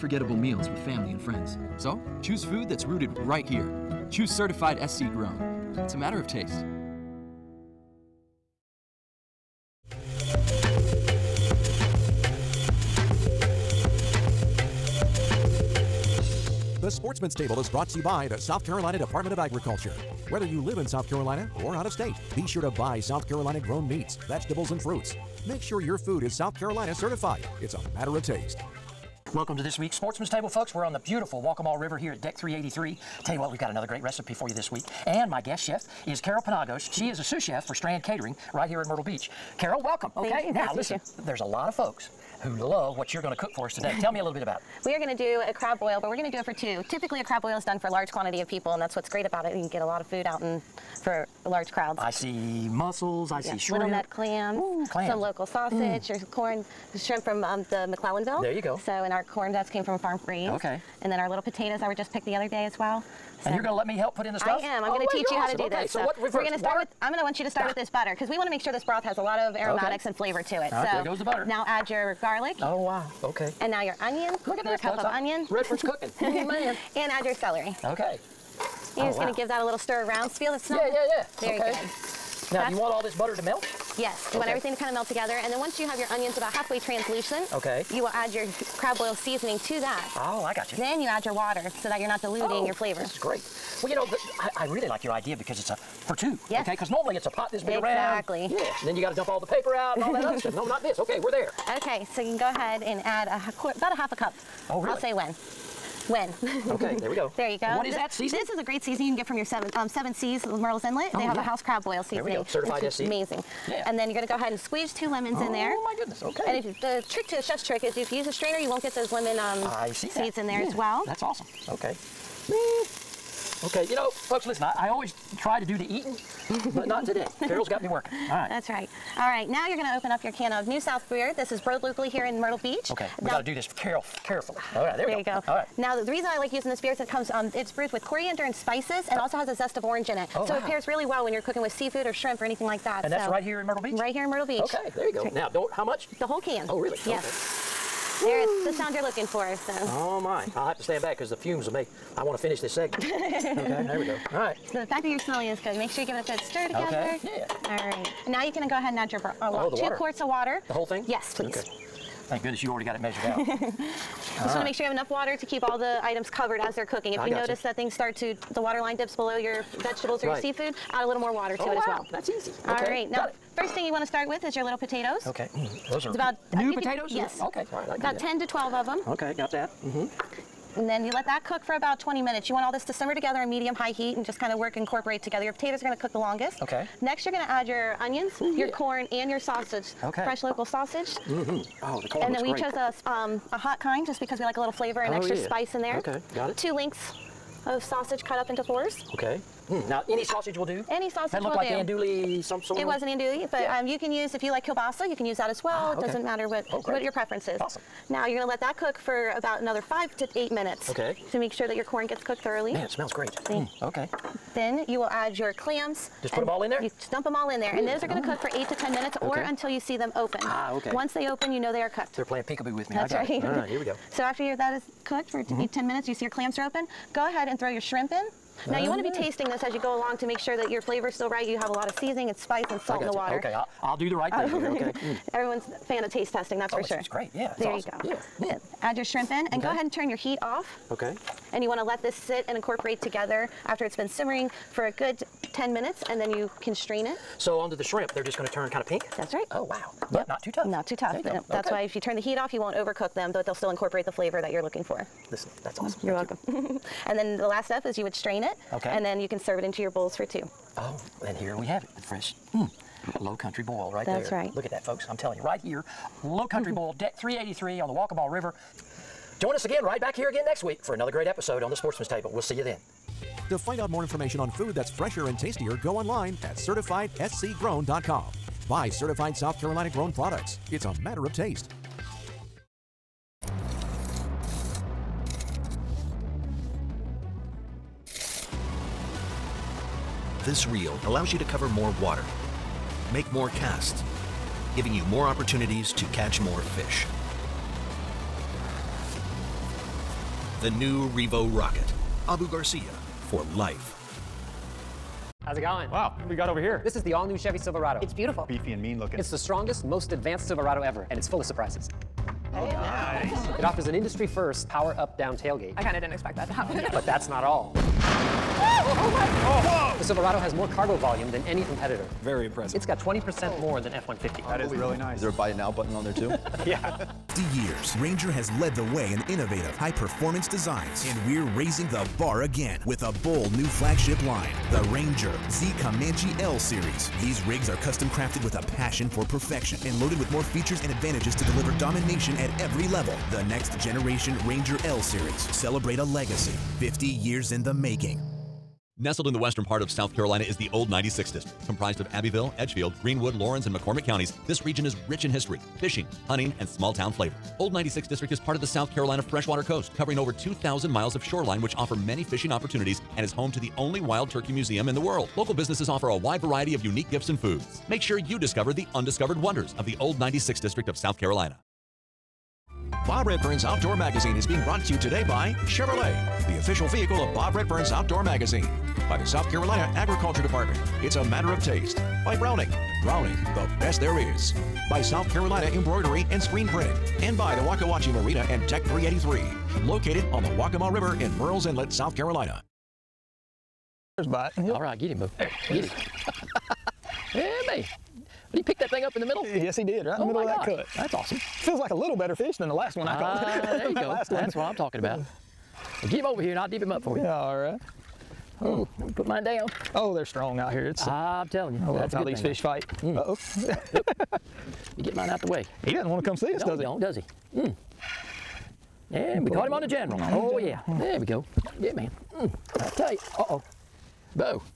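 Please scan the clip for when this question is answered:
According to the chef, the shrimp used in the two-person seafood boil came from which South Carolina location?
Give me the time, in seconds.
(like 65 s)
57 s.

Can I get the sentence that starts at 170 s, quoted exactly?
your seafood, add a little more water to oh, it wow.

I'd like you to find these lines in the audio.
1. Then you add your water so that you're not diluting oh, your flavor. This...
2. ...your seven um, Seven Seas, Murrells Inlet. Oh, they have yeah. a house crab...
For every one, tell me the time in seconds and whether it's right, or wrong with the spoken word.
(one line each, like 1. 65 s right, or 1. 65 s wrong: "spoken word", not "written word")
1. 90 s right
2. 109 s right.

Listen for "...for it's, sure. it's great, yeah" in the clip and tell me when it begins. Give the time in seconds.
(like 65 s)
236 s.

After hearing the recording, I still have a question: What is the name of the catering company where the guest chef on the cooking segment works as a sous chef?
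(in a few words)
Strand Catering.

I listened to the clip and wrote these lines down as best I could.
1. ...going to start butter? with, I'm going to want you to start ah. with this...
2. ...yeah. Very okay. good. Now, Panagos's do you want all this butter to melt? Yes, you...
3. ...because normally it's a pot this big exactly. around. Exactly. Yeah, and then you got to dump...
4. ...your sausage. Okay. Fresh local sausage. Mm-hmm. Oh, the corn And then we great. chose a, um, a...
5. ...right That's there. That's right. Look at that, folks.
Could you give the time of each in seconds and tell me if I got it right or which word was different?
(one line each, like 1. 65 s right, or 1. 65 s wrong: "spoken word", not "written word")
1. 66 s wrong: "water", not "butter"
2. 81 s wrong: "That", not "Panagos"
3. 96 s right
4. 189 s right
5. 263 s right.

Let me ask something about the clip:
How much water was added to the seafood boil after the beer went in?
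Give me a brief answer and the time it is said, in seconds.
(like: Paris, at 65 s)
2 quarts, at 159 s.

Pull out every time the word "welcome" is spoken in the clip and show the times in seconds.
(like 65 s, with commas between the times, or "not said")
29 s, 39 s, 256 s.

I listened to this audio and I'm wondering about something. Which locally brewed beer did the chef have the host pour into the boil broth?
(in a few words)
New South Beer.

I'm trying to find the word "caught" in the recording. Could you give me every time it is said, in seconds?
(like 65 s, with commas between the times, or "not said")
403 s, 419 s.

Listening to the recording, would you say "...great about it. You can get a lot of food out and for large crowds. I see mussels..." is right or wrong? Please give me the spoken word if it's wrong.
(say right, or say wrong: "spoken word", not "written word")
right.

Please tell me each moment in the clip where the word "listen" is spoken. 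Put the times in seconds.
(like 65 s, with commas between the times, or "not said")
40 s, 124 s, 255 s.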